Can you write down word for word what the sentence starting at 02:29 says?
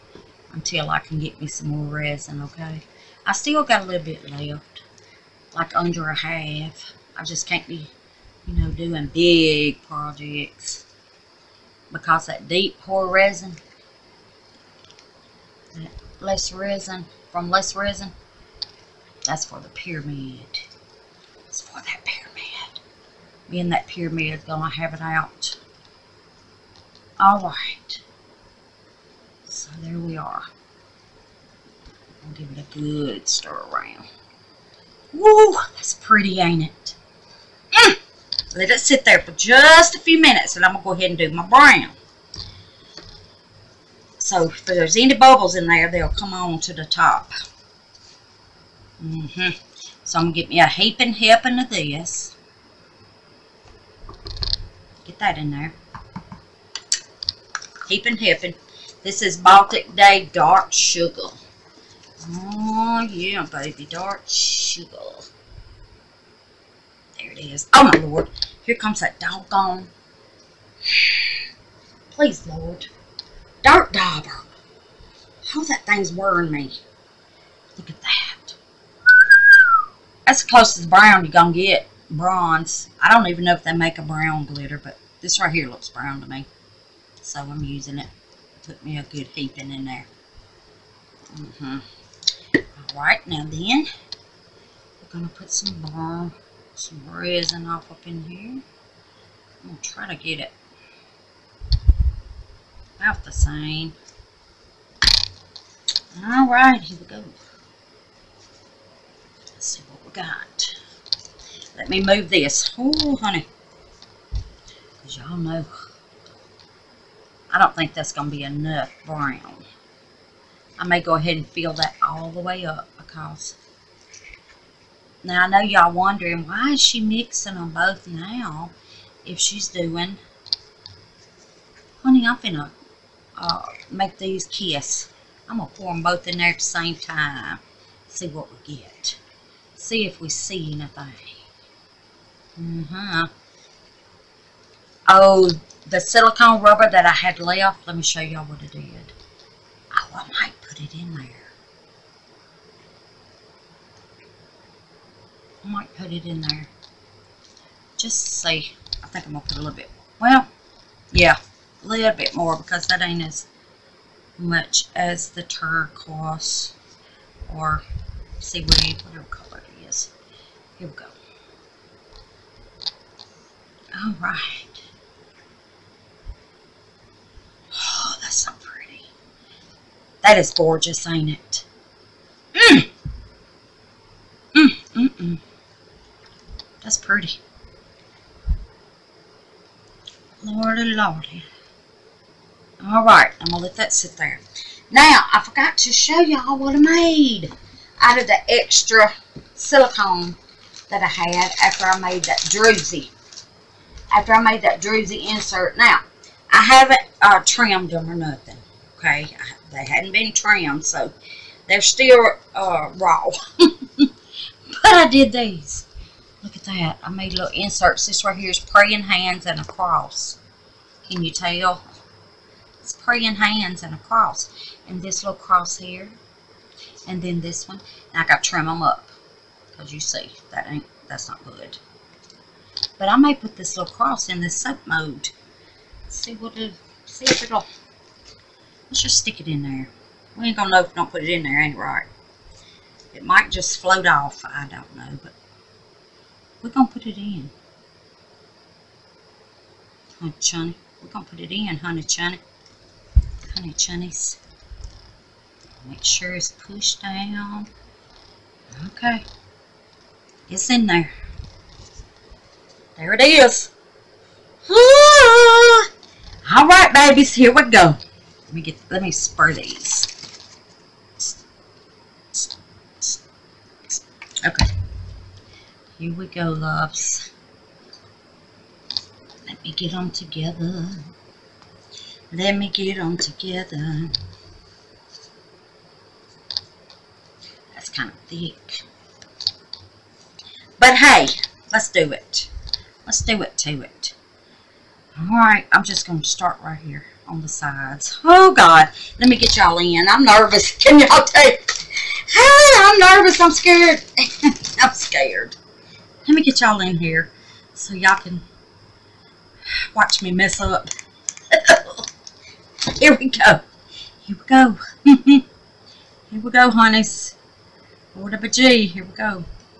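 Oh, I might put it in there.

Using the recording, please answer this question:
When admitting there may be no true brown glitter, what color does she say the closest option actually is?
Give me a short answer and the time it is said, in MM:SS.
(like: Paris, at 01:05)
Bronze, at 01:22.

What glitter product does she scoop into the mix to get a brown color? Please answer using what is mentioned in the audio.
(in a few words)
Baltic Day Dark Sugar.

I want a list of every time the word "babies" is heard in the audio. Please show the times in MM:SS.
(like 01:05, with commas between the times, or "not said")
04:26.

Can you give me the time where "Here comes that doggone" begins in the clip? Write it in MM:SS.
01:08.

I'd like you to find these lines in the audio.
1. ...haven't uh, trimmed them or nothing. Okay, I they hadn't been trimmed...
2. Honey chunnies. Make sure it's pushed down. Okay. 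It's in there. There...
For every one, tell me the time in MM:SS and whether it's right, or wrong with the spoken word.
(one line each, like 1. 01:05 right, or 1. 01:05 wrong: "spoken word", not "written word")
1. 03:26 right
2. 04:13 right.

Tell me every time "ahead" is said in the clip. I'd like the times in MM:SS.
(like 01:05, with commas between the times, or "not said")
00:40, 02:01.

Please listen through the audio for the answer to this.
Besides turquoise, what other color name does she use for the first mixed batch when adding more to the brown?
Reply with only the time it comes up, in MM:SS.
02:48.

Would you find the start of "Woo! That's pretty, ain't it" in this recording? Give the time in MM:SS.
00:35.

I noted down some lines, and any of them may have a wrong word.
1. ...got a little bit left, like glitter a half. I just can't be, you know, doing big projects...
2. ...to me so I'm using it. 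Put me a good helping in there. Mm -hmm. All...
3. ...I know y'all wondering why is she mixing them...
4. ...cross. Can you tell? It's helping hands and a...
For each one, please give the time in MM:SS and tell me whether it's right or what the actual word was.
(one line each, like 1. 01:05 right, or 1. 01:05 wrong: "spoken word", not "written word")
1. 00:03 wrong: "under", not "glitter"
2. 01:26 wrong: "heaping", not "helping"
3. 02:05 right
4. 03:39 wrong: "praying", not "helping".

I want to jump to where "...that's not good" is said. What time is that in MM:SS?
03:51.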